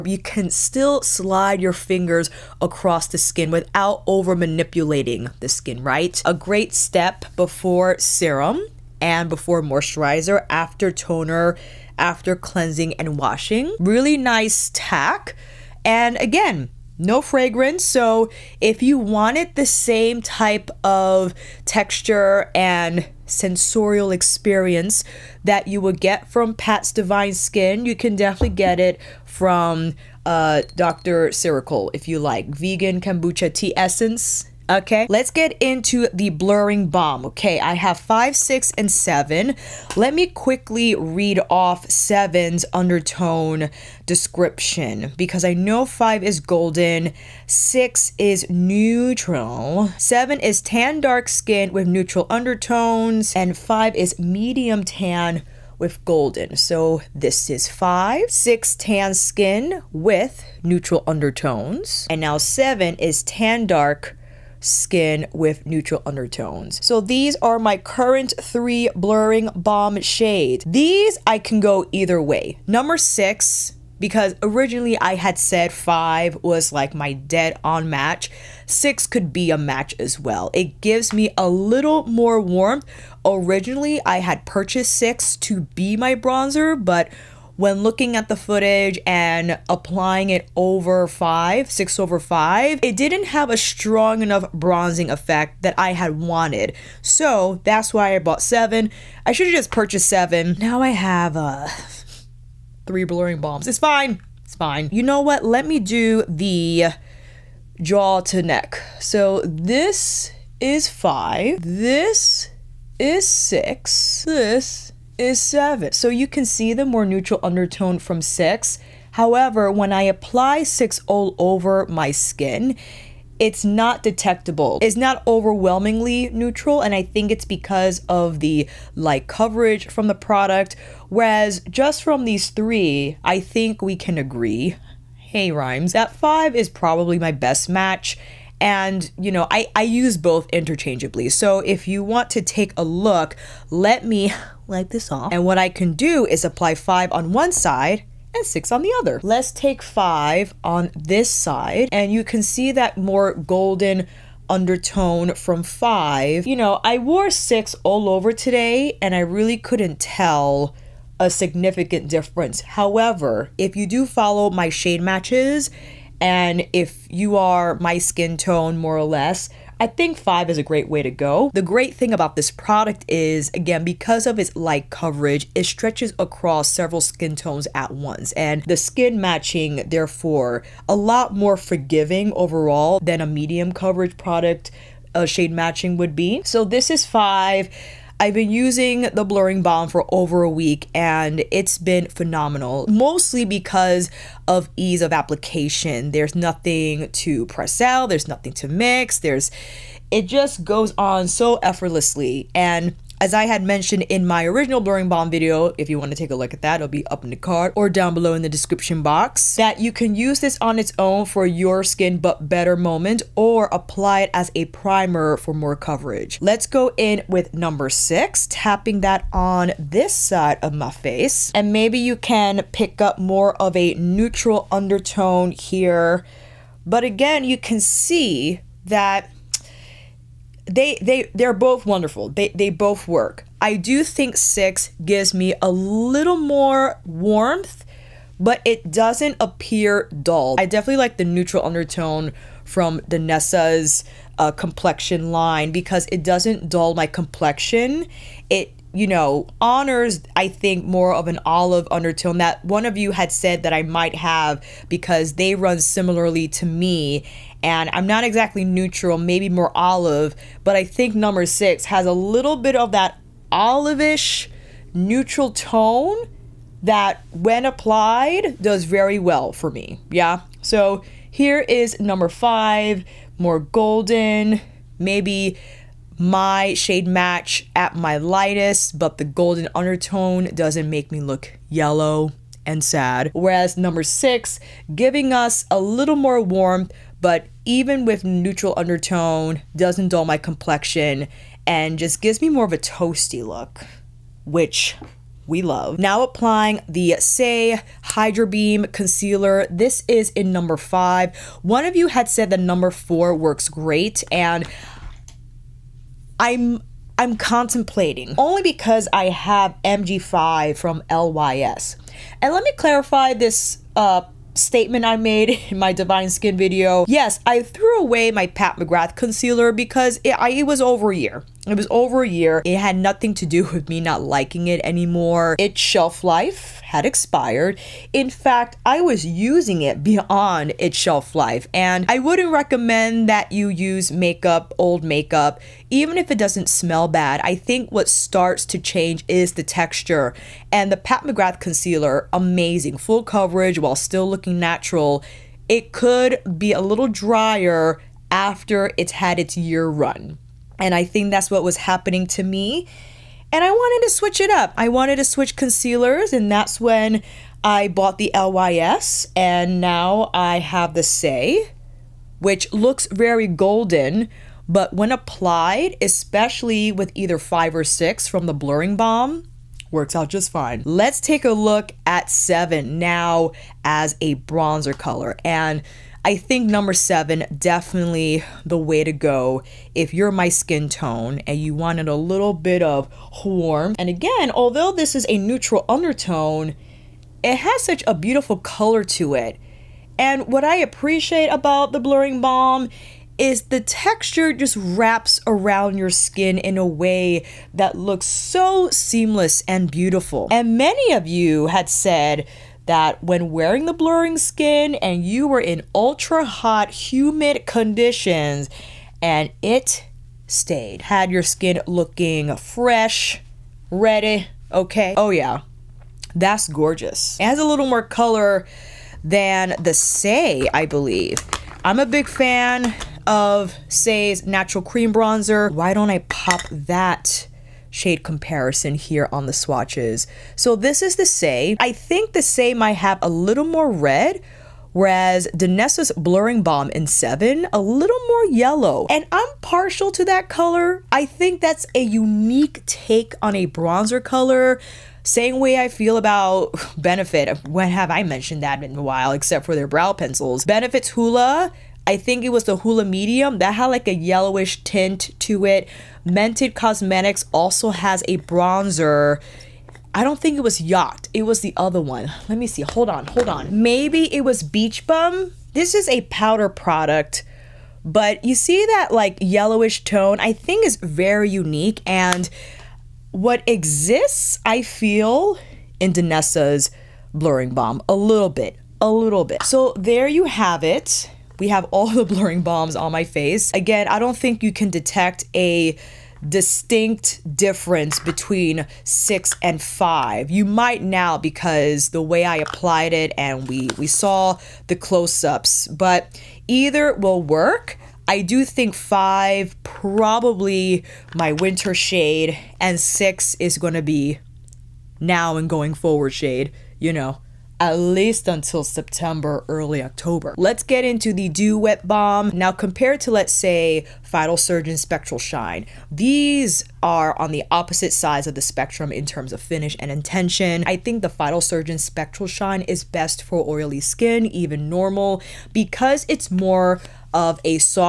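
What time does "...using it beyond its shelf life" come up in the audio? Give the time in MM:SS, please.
05:29.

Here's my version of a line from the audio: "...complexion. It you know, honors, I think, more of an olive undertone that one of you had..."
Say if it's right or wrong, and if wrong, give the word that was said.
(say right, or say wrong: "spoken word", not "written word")
right.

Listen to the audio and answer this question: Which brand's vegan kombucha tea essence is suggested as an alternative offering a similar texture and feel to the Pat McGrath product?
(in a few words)
Dr. Ceuracle.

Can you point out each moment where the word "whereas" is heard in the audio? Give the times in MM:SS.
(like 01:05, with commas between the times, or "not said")
02:11, 04:43, 07:14.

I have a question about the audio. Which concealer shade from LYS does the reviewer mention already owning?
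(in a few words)
MG5.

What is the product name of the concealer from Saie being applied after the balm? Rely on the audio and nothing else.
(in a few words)
Hydro Beam Concealer.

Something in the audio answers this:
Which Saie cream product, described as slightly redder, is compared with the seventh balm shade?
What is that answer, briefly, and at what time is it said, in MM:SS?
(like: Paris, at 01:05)
Natural Cream Bronzer, at 07:04.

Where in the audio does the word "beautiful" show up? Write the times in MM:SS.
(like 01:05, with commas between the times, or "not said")
06:28, 06:39.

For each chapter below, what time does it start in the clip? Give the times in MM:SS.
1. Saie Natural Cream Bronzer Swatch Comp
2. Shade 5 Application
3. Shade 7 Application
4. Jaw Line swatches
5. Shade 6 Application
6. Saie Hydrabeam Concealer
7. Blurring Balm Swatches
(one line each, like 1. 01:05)
1. 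07:05
2. 02:29
3. 06:11
4. 01:34
5. 03:36
6. 04:56
7. 00:53.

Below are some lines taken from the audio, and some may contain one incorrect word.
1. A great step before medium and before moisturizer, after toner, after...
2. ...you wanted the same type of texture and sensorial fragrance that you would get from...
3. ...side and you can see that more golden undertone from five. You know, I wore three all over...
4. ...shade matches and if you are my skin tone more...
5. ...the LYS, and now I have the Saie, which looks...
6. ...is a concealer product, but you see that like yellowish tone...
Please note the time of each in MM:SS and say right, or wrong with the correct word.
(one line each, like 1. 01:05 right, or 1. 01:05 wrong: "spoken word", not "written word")
1. 00:06 wrong: "serum", not "medium"
2. 00:18 wrong: "experience", not "fragrance"
3. 02:31 wrong: "six", not "three"
4. 02:44 right
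5. 05:58 right
6. 07:45 wrong: "powder", not "concealer".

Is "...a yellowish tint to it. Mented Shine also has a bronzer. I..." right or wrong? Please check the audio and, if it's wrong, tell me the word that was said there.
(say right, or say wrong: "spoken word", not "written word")
wrong: "Cosmetics", not "Shine".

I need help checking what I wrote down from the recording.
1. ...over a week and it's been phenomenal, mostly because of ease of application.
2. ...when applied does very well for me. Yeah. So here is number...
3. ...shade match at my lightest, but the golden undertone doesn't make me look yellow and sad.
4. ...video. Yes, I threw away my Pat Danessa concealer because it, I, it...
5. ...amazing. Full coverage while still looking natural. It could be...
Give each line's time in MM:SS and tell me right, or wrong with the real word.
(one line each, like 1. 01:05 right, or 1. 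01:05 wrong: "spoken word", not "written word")
1. 03:10 right
2. 04:27 right
3. 04:36 right
4. 05:16 wrong: "McGrath", not "Danessa"
5. 05:42 right.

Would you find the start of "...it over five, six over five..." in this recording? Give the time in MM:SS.
01:30.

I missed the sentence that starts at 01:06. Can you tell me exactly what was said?
So these are my current three blurring balm shades.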